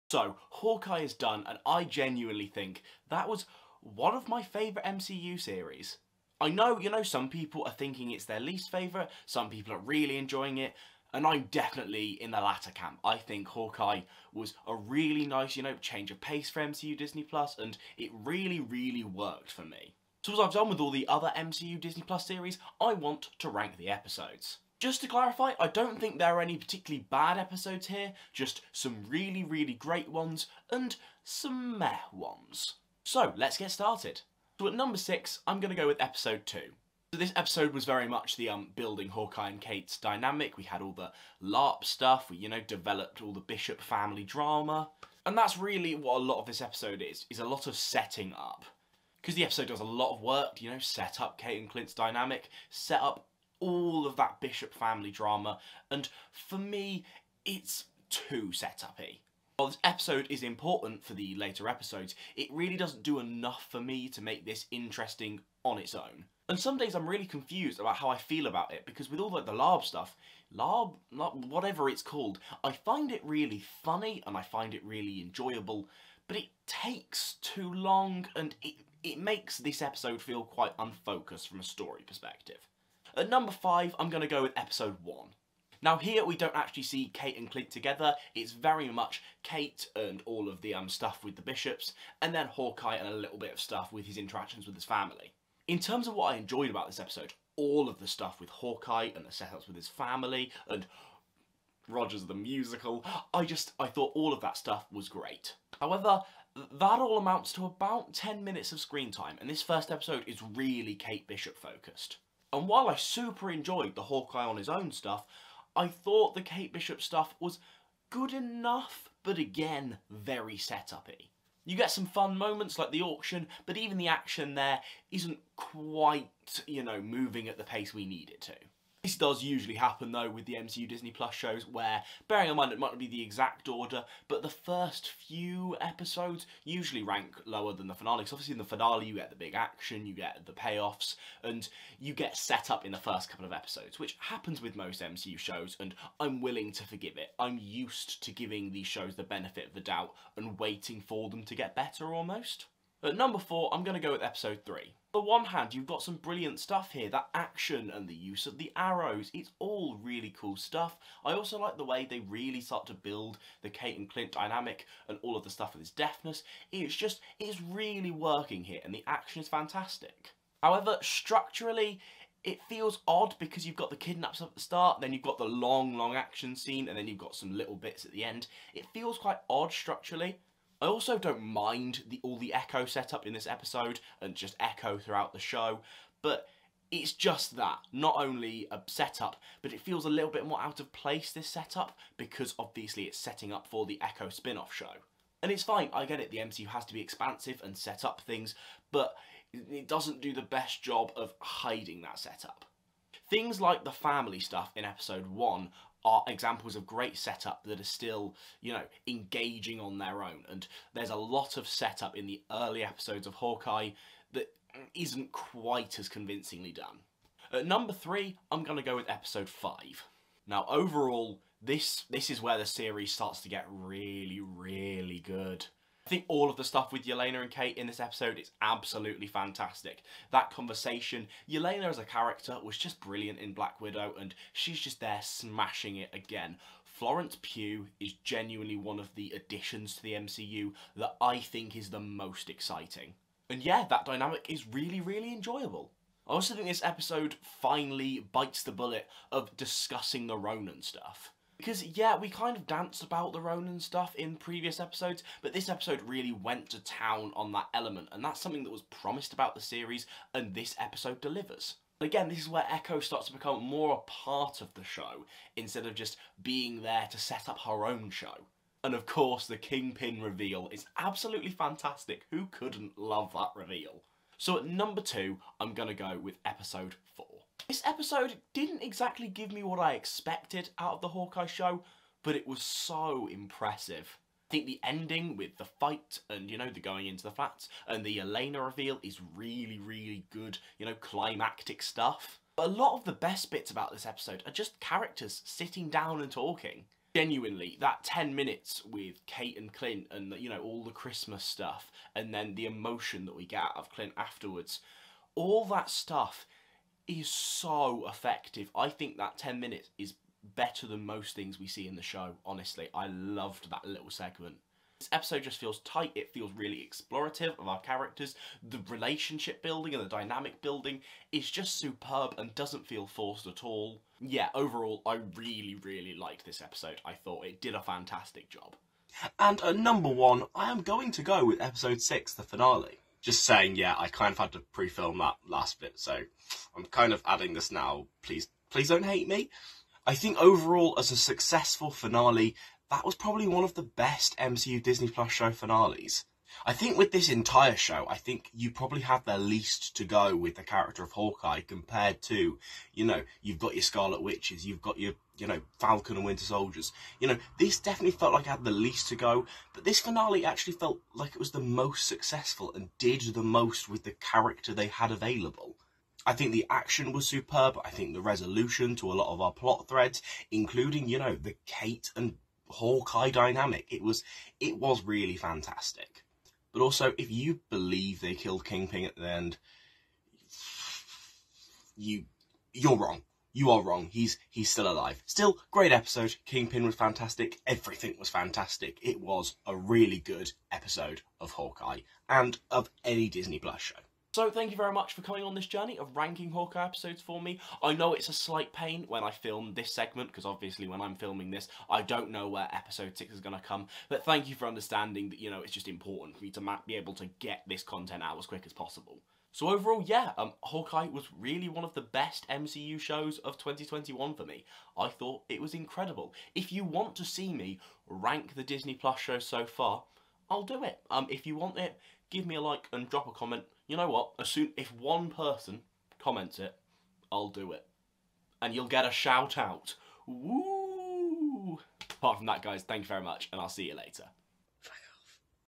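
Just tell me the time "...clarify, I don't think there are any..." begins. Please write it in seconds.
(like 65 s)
25 s.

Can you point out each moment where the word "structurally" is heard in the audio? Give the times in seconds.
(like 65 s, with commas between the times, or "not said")
171 s, 179 s.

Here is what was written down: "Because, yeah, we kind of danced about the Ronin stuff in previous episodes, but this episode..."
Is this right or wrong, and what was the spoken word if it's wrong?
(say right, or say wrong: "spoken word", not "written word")
right.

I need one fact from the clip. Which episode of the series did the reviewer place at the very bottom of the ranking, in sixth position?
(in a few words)
Episode 2.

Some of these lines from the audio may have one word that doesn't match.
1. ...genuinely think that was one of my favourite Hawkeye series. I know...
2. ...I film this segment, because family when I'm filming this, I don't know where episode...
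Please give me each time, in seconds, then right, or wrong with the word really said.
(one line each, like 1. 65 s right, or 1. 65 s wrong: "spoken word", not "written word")
1. 1 s wrong: "MCU", not "Hawkeye"
2. 399 s wrong: "obviously", not "family".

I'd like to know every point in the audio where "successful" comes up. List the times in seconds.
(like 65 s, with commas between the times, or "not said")
341 s, 362 s.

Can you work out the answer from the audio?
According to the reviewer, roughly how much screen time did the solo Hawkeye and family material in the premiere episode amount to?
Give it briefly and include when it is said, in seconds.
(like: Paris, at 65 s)
10 minutes, at 107 s.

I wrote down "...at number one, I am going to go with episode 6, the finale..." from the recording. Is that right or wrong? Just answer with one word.
right.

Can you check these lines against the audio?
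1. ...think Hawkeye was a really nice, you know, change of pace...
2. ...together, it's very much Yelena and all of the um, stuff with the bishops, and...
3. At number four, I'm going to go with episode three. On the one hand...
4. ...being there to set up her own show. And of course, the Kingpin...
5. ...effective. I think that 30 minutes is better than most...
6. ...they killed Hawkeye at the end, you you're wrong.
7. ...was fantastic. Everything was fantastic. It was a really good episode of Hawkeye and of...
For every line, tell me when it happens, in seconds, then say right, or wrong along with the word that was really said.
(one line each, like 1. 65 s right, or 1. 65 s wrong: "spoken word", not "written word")
1. 13 s right
2. 87 s wrong: "Kate", not "Yelena"
3. 153 s right
4. 266 s right
5. 308 s wrong: "10", not "30"
6. 378 s wrong: "Kingpin", not "Hawkeye"
7. 386 s right.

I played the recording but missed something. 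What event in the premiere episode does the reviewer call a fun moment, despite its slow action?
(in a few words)
The auction.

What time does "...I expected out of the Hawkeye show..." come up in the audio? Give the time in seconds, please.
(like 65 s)
279 s.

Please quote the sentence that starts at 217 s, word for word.
At number three, I'm going to go with episode five.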